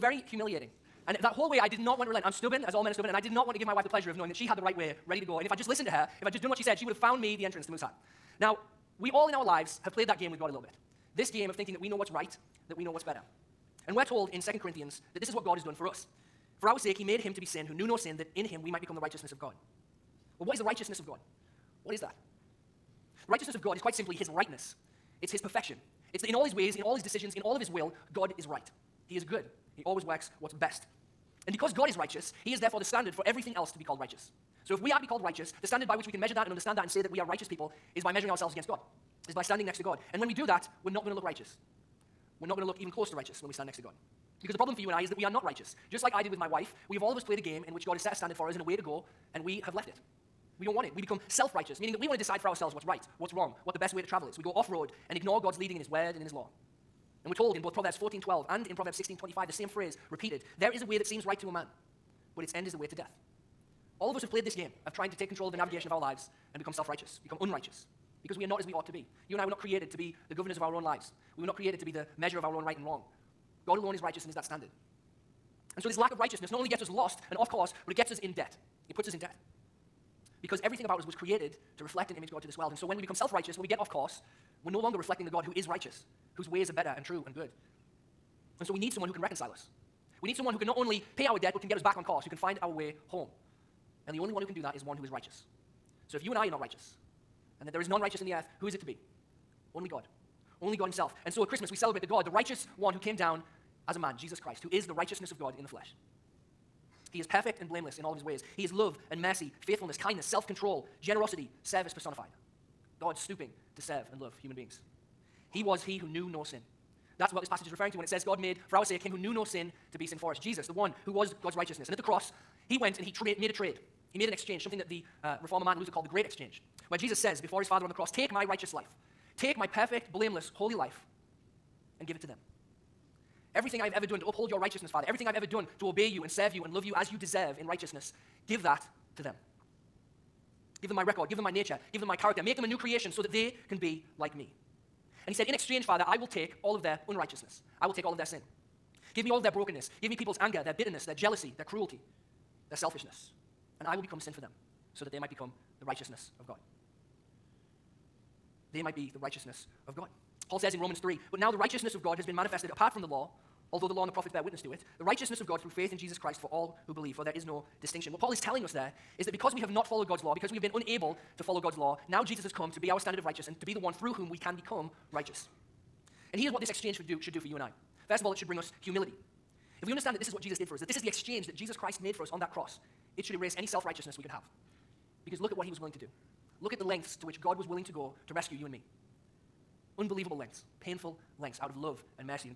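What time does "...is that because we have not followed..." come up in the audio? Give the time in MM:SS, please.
02:49.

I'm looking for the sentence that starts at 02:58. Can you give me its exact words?
First of all, it should bring us humility.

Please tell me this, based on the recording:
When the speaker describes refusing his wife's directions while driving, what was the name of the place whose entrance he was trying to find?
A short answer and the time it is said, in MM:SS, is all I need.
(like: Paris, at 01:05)
Mooseheart, at 00:07.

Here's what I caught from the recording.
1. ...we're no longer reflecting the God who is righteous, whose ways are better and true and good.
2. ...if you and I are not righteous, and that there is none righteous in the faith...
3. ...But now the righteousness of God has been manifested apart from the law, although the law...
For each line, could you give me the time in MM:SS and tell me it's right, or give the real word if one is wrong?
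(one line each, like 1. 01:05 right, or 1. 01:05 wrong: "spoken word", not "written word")
1. 01:24 right
2. 01:36 wrong: "earth", not "faith"
3. 02:41 right.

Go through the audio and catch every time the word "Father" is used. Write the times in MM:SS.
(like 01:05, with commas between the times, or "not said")
02:07, 02:14, 02:25.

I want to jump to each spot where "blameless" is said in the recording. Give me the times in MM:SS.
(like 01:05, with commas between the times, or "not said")
01:47, 02:10.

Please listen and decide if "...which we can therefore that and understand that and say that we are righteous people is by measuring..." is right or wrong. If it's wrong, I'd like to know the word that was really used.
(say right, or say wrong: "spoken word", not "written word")
wrong: "measure", not "therefore".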